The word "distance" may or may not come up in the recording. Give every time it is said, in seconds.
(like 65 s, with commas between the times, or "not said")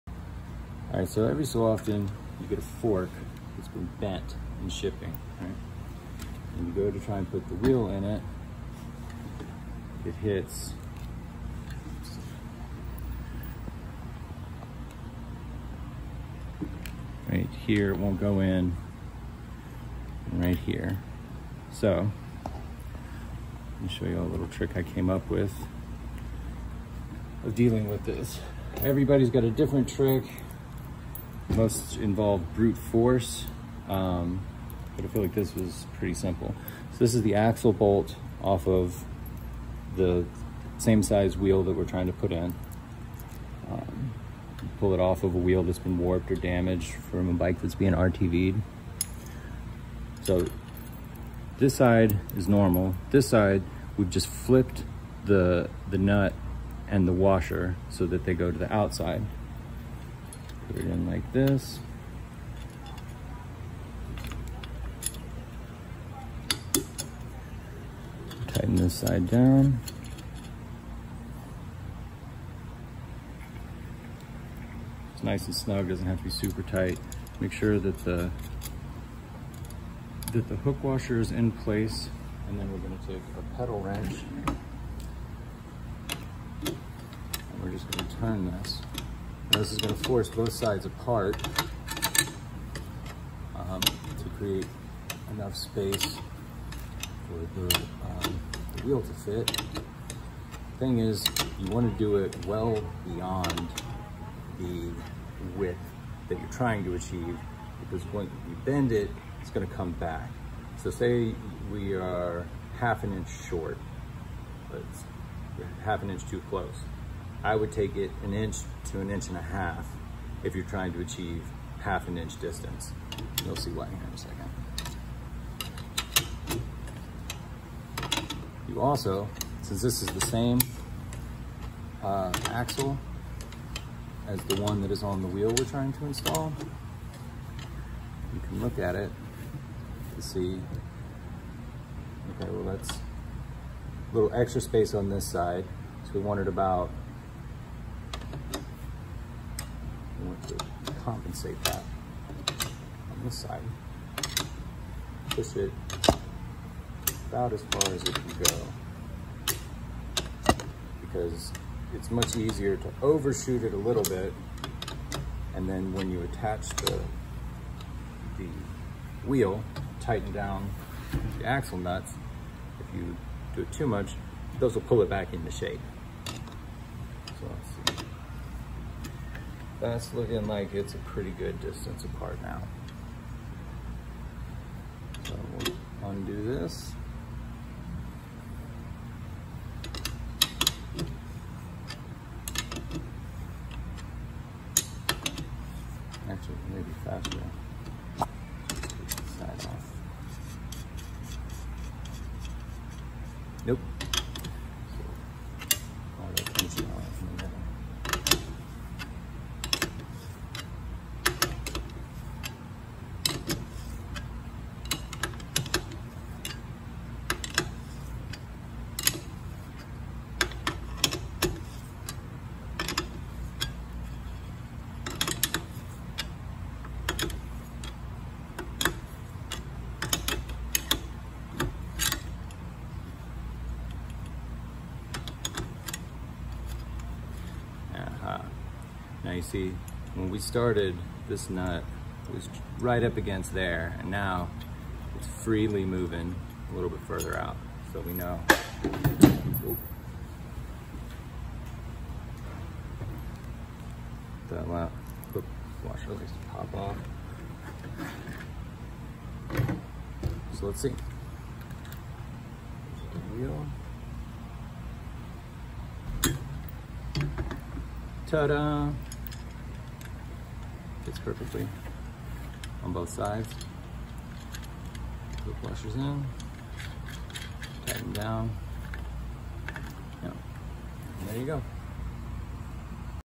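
122 s, 181 s.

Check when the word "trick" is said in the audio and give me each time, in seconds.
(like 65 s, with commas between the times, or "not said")
24 s, 29 s.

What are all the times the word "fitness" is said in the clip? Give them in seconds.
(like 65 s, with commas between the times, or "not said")
not said.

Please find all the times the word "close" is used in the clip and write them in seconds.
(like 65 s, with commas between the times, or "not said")
116 s.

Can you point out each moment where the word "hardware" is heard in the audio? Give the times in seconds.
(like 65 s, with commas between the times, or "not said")
not said.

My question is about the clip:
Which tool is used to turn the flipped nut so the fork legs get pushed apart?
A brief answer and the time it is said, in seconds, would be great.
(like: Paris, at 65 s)
pedal wrench, at 83 s.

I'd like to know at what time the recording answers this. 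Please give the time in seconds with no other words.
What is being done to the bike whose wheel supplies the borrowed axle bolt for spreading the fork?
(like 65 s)
47 s.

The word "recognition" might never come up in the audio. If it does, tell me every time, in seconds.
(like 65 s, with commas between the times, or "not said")
not said.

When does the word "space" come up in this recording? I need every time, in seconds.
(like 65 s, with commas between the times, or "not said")
95 s, 144 s.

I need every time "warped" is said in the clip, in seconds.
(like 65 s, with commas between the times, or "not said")
45 s.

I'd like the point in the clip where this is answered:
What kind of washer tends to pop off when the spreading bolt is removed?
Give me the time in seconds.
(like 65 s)
254 s.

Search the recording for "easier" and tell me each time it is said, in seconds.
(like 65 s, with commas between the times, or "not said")
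162 s.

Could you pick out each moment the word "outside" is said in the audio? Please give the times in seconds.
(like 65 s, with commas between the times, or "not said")
58 s.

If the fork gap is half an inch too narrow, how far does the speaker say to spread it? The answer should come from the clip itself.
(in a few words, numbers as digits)
1 to 1.5 inches.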